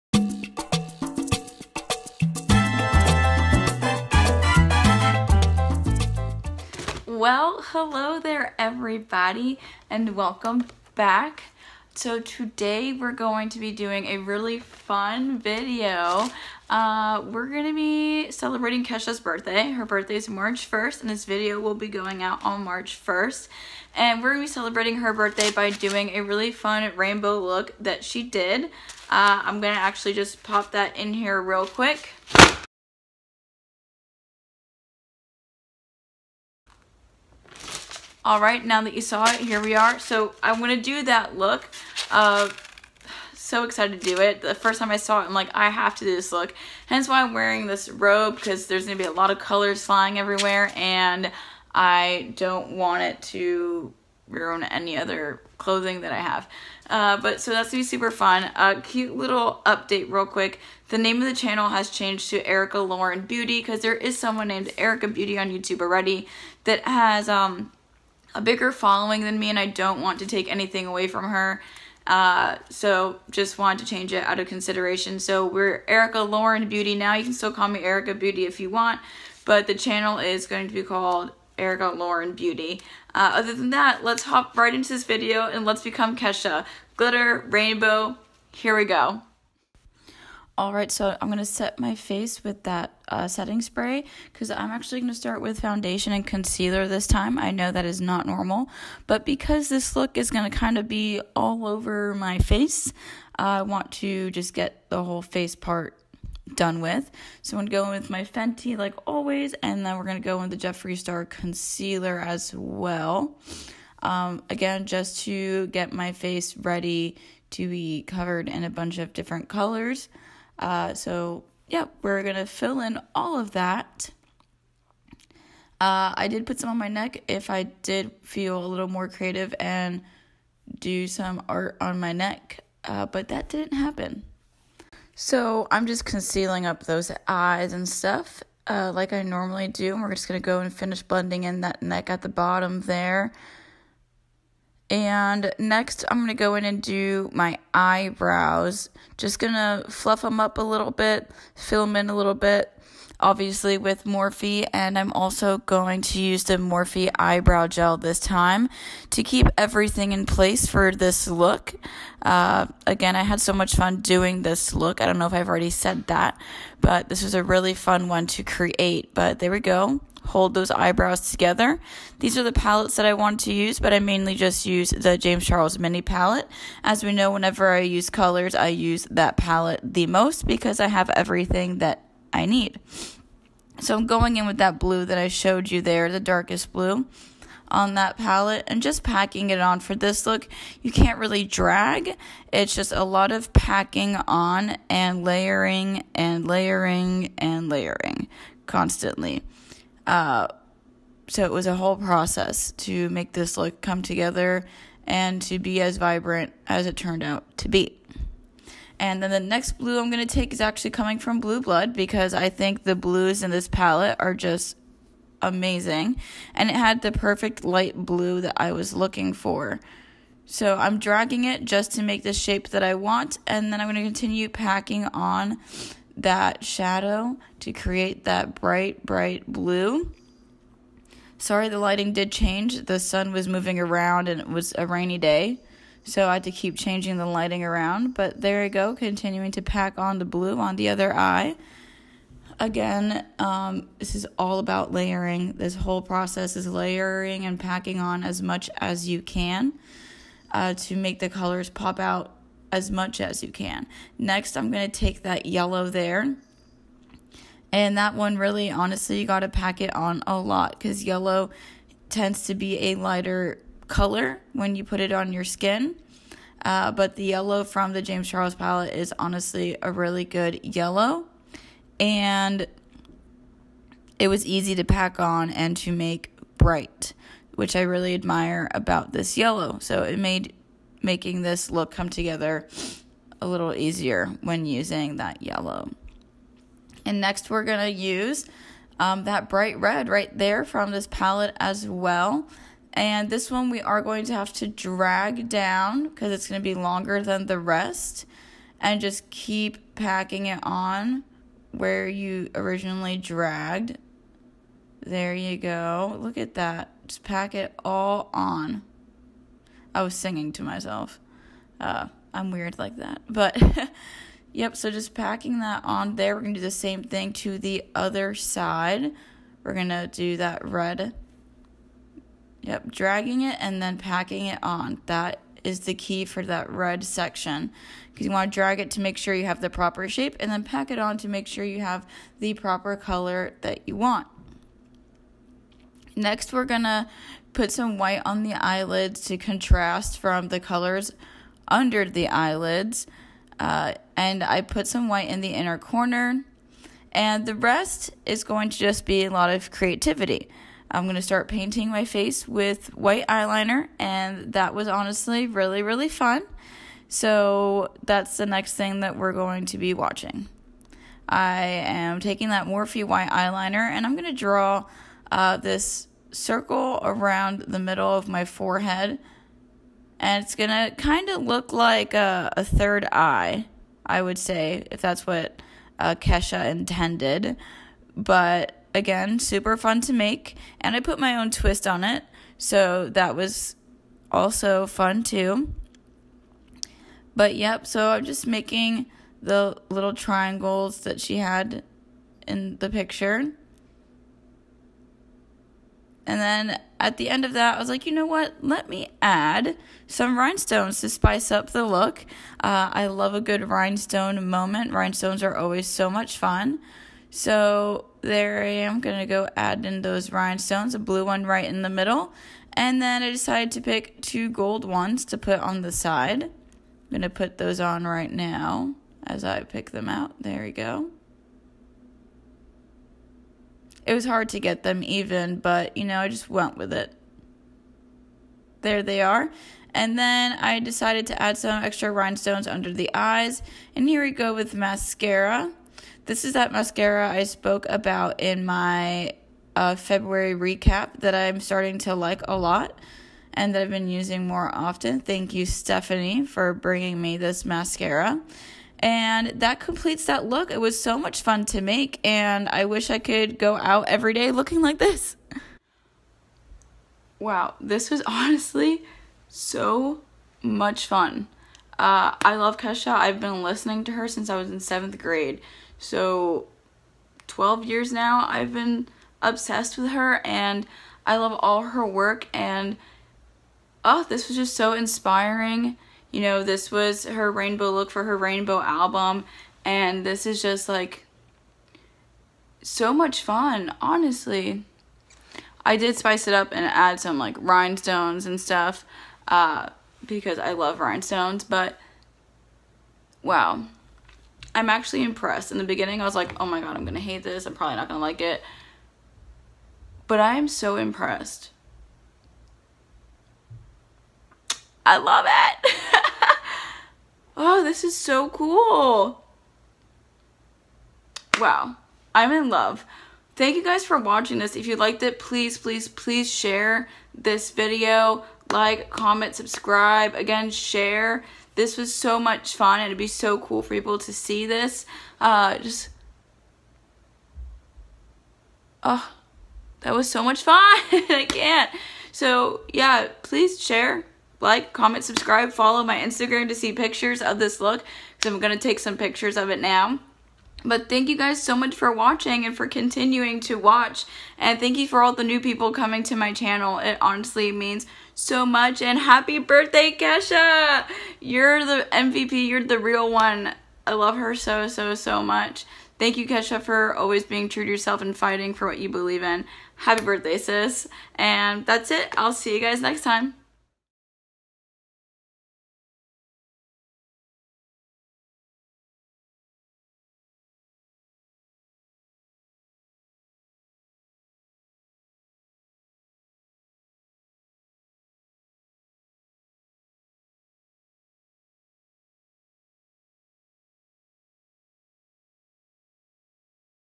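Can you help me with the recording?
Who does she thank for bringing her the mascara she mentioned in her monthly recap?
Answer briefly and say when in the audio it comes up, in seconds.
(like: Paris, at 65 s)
Stephanie, at 445 s.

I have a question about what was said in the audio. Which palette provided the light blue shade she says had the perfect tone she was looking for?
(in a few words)
Blue Blood.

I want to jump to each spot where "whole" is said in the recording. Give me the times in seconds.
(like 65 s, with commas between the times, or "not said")
105 s, 201 s, 245 s.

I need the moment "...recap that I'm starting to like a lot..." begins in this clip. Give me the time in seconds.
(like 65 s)
440 s.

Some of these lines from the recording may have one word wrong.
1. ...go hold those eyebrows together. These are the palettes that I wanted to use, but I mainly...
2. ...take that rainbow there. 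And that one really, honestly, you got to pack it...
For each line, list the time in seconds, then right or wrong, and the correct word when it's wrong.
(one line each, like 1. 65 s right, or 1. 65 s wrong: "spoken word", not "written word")
1. 169 s right
2. 254 s wrong: "yellow", not "rainbow".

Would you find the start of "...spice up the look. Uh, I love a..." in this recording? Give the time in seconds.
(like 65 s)
401 s.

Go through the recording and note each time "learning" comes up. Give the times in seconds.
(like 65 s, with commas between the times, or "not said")
not said.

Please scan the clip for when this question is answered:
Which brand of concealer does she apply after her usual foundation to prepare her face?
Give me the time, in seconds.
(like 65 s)
110 s.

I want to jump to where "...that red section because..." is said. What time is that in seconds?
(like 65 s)
326 s.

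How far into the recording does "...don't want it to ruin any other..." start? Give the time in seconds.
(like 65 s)
52 s.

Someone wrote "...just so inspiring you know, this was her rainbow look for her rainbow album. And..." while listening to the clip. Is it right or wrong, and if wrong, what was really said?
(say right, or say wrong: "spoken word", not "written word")
right.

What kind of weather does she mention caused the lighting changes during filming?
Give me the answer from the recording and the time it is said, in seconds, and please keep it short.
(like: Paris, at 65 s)
rainy, at 234 s.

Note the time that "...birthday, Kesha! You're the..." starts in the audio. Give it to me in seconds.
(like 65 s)
549 s.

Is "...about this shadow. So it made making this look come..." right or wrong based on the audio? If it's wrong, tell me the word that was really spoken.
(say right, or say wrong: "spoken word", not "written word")
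wrong: "yellow", not "shadow".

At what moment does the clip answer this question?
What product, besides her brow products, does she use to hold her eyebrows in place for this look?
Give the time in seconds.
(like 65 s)
156 s.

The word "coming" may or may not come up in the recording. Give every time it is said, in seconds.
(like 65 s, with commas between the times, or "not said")
210 s, 545 s.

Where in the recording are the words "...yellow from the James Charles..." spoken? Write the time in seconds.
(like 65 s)
267 s.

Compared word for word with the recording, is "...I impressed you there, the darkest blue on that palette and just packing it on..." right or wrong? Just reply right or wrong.
wrong.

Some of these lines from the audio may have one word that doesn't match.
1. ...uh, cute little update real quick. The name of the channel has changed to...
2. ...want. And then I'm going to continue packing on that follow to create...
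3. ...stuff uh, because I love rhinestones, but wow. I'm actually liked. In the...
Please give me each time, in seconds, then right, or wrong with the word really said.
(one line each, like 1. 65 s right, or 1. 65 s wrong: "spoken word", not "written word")
1. 58 s right
2. 222 s wrong: "shadow", not "follow"
3. 488 s wrong: "impressed", not "liked".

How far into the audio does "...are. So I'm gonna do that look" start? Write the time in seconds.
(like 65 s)
39 s.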